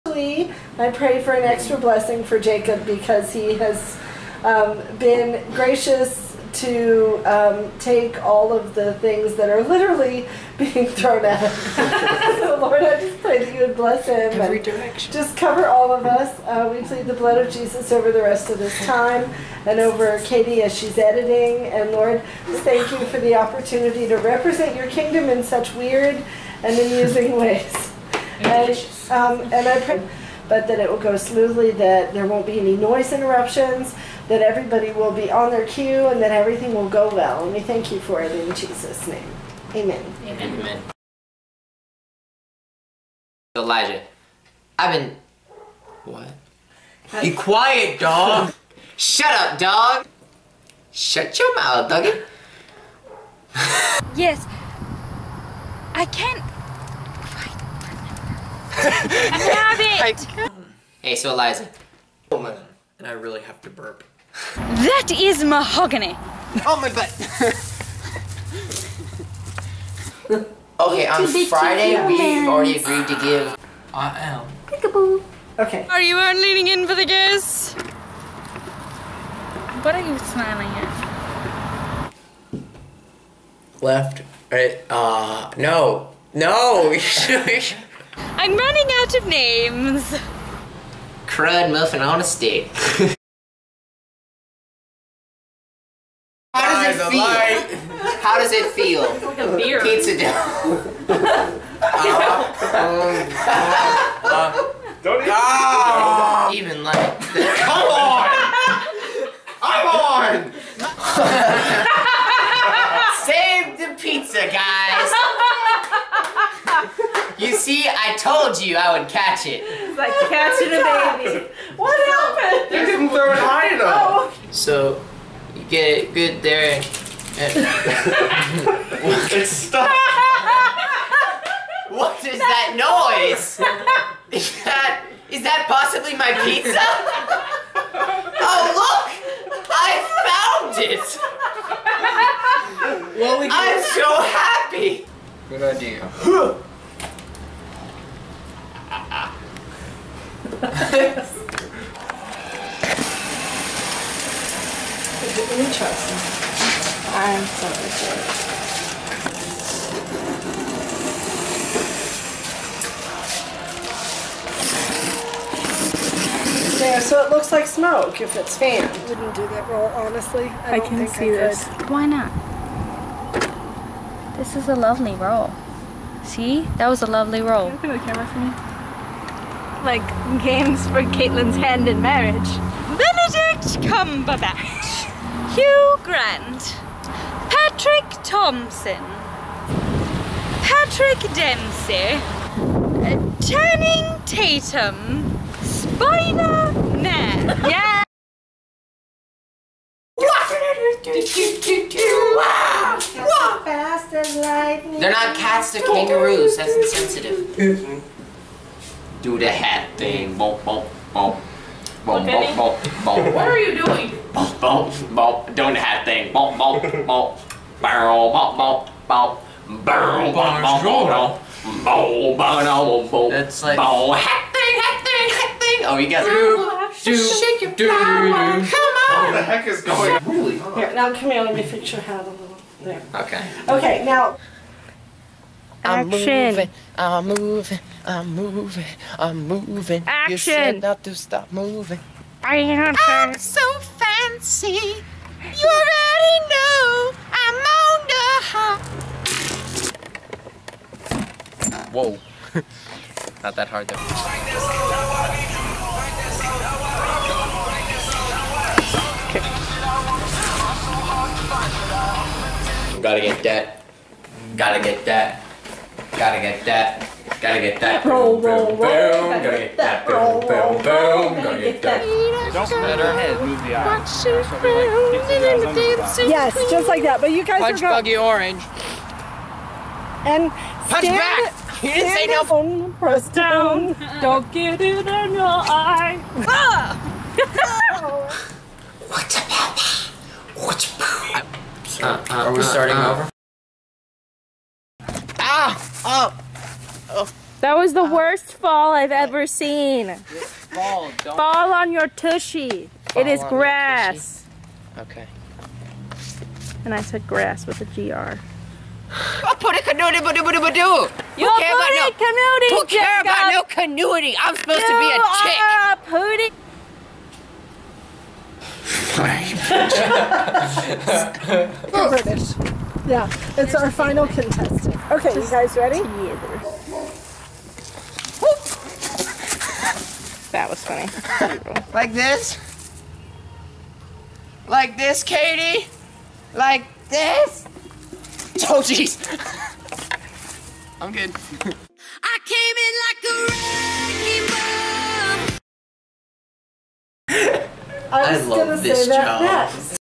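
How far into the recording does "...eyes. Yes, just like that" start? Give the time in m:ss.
4:33.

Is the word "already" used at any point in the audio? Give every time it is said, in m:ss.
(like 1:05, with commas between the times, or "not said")
1:12, 4:05.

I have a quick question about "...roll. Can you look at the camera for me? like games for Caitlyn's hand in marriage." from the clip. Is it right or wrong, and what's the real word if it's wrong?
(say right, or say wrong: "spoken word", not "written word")
right.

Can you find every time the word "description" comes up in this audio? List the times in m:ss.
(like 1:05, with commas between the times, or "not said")
not said.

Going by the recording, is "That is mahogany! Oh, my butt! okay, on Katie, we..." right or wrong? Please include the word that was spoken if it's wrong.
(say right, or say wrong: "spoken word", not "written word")
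wrong: "Friday", not "Katie".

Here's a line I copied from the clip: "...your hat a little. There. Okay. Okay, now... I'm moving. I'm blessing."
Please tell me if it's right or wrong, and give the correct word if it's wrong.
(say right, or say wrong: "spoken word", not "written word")
wrong: "moving", not "blessing".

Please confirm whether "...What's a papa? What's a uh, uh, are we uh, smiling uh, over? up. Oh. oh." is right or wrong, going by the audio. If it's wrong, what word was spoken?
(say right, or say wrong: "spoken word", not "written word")
wrong: "starting", not "smiling".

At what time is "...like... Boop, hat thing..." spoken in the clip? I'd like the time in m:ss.
3:43.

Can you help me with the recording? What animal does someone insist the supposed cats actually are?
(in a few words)
kangaroos.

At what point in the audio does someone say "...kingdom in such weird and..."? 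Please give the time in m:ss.
0:24.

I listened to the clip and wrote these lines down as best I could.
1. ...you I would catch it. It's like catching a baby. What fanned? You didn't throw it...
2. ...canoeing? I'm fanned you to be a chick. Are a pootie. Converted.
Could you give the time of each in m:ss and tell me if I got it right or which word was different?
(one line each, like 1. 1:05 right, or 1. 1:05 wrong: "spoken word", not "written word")
1. 1:58 wrong: "happened", not "fanned"
2. 5:13 wrong: "supposed", not "fanned".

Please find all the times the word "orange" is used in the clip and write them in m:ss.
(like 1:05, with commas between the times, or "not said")
4:38.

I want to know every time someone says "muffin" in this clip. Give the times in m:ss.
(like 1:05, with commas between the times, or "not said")
1:31.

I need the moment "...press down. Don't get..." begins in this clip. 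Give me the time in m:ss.
4:42.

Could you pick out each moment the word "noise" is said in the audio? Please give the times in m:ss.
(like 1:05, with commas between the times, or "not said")
0:32, 2:12.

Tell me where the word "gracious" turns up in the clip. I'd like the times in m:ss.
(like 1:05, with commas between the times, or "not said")
0:05.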